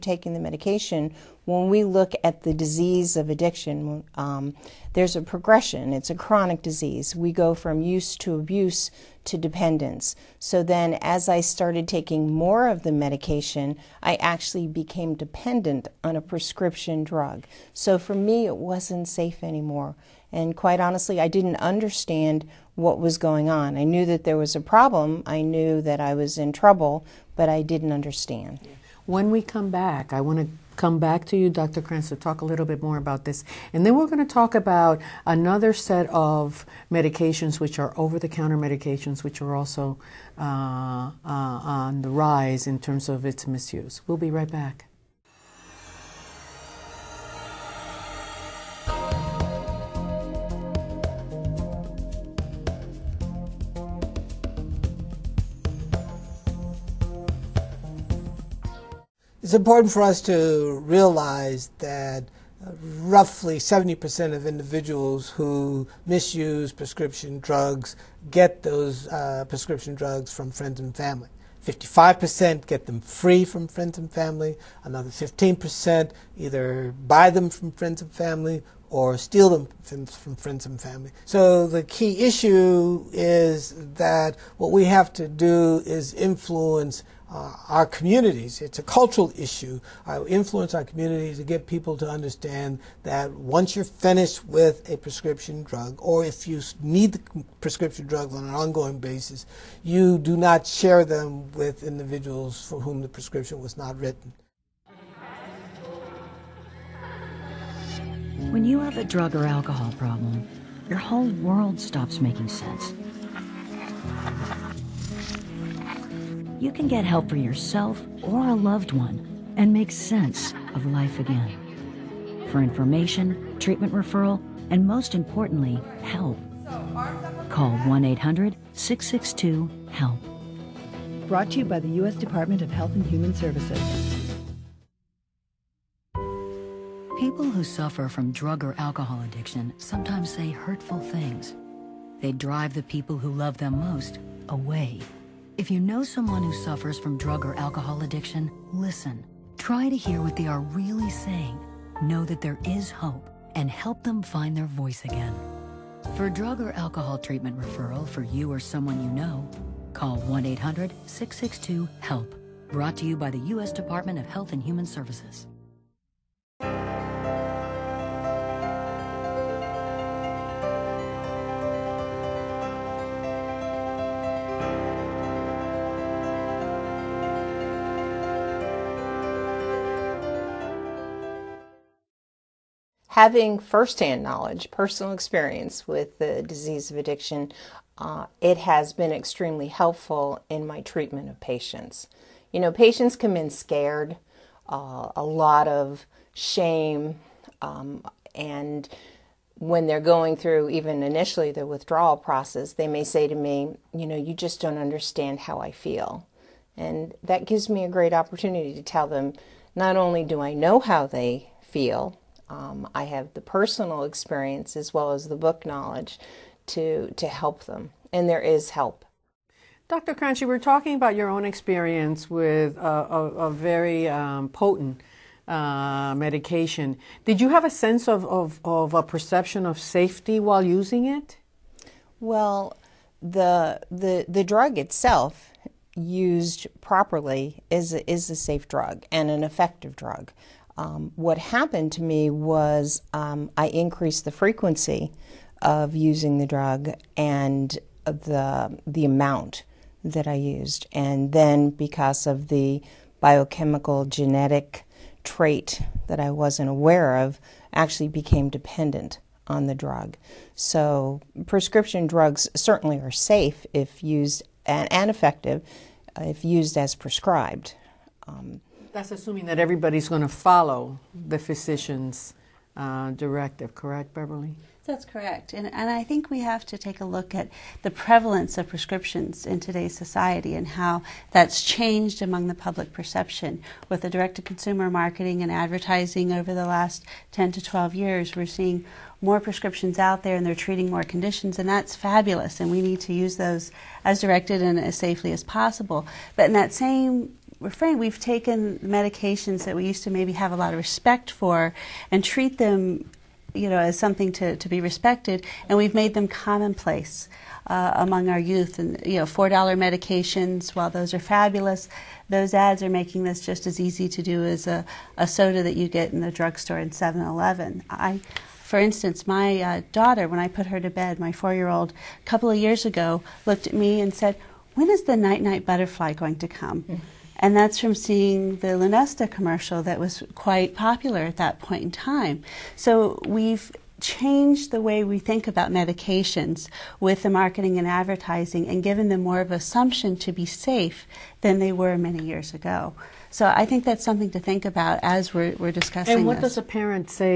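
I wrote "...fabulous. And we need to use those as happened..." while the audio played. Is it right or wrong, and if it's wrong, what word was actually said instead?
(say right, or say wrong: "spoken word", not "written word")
wrong: "directed", not "happened".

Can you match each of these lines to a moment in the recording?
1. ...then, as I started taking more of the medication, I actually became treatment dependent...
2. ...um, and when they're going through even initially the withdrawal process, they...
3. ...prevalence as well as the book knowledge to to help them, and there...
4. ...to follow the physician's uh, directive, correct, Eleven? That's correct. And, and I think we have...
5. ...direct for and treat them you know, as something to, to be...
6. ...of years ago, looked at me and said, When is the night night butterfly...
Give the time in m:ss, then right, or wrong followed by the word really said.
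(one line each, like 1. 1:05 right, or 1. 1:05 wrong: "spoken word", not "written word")
1. 0:10 wrong: "dependent", not "treatment"
2. 3:17 right
3. 3:34 wrong: "experience", not "prevalence"
4. 4:30 wrong: "Beverly", not "Eleven"
5. 5:00 wrong: "respect", not "direct"
6. 5:22 right.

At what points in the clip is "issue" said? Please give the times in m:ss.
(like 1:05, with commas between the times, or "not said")
1:22, 1:29.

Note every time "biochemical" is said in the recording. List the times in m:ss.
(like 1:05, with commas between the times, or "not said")
4:13.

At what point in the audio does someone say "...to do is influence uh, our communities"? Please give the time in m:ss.
1:25.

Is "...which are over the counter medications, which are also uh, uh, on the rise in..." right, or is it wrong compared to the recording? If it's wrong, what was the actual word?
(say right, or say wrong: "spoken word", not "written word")
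right.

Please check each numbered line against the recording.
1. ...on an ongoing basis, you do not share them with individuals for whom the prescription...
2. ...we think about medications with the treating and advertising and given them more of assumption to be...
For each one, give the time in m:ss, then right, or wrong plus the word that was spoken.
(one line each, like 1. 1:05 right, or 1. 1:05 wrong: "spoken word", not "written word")
1. 1:38 right
2. 5:35 wrong: "marketing", not "treating".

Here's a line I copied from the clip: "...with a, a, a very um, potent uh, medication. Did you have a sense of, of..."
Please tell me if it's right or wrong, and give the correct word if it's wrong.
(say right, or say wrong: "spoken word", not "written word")
right.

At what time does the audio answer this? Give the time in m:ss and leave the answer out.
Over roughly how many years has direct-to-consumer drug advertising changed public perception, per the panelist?
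4:47.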